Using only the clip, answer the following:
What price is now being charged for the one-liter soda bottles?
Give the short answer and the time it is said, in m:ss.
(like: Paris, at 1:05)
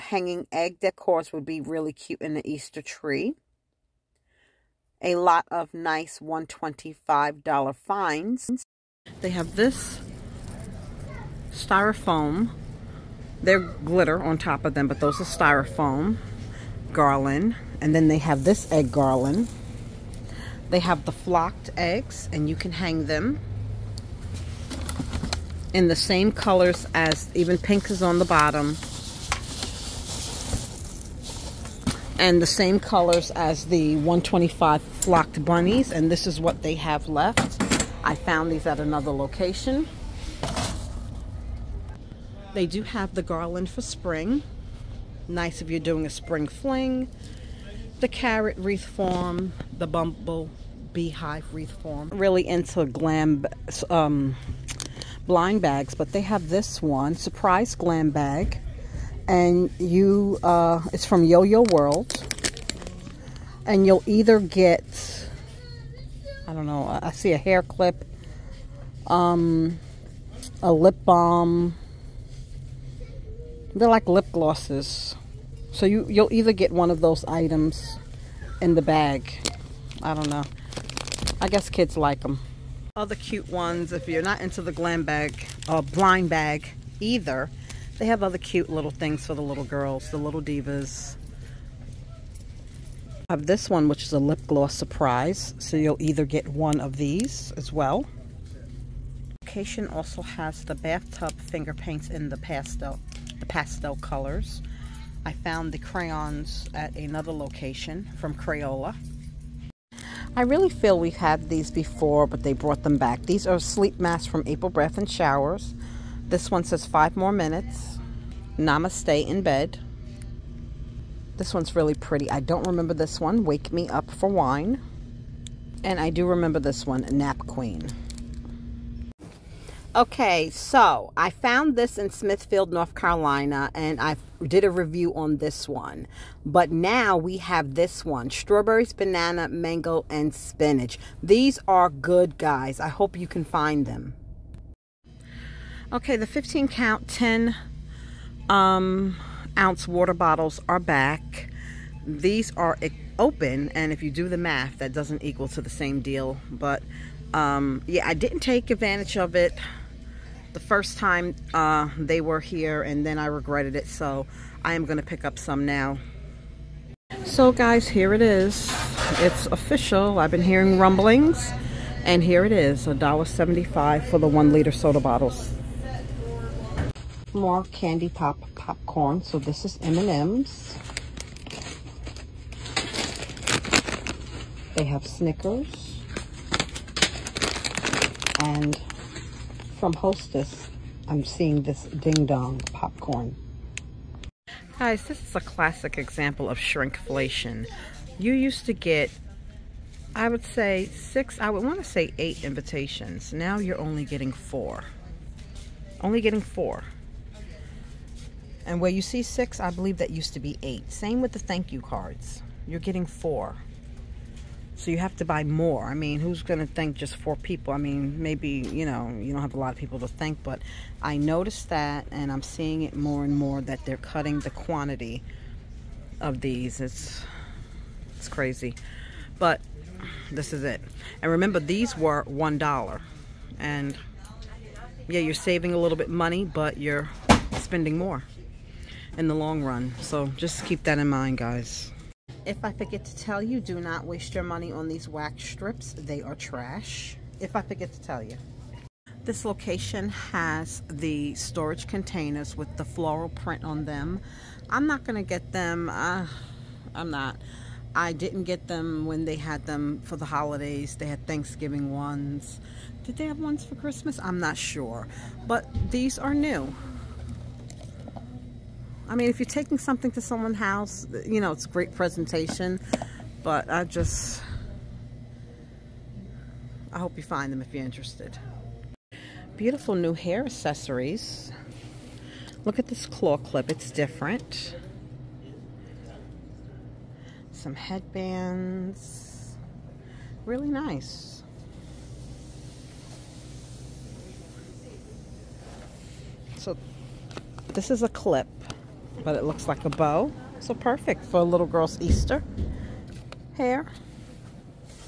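$1.75, at 2:52.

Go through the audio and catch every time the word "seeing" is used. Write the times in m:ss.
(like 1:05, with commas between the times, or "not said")
3:11, 3:42.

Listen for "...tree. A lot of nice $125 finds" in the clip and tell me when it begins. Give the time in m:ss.
0:02.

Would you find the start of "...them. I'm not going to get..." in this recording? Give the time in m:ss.
4:13.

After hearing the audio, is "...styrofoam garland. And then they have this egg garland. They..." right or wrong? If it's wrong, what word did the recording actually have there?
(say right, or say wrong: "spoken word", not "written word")
right.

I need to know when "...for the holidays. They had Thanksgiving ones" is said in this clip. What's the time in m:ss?
4:20.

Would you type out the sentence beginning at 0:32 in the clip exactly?
And the same colors as the 125 flocked bunnies.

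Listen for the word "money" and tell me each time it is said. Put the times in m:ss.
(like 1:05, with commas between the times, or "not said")
3:56, 4:04.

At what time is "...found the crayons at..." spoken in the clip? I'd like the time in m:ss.
1:45.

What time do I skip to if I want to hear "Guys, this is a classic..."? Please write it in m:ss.
3:14.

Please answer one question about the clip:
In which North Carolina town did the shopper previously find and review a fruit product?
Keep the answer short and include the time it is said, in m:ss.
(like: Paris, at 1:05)
Smithfield, at 2:12.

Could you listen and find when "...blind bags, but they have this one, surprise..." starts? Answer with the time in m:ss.
0:55.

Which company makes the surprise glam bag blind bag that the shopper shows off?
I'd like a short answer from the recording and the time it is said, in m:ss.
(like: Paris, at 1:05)
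Yo-Yo World, at 1:01.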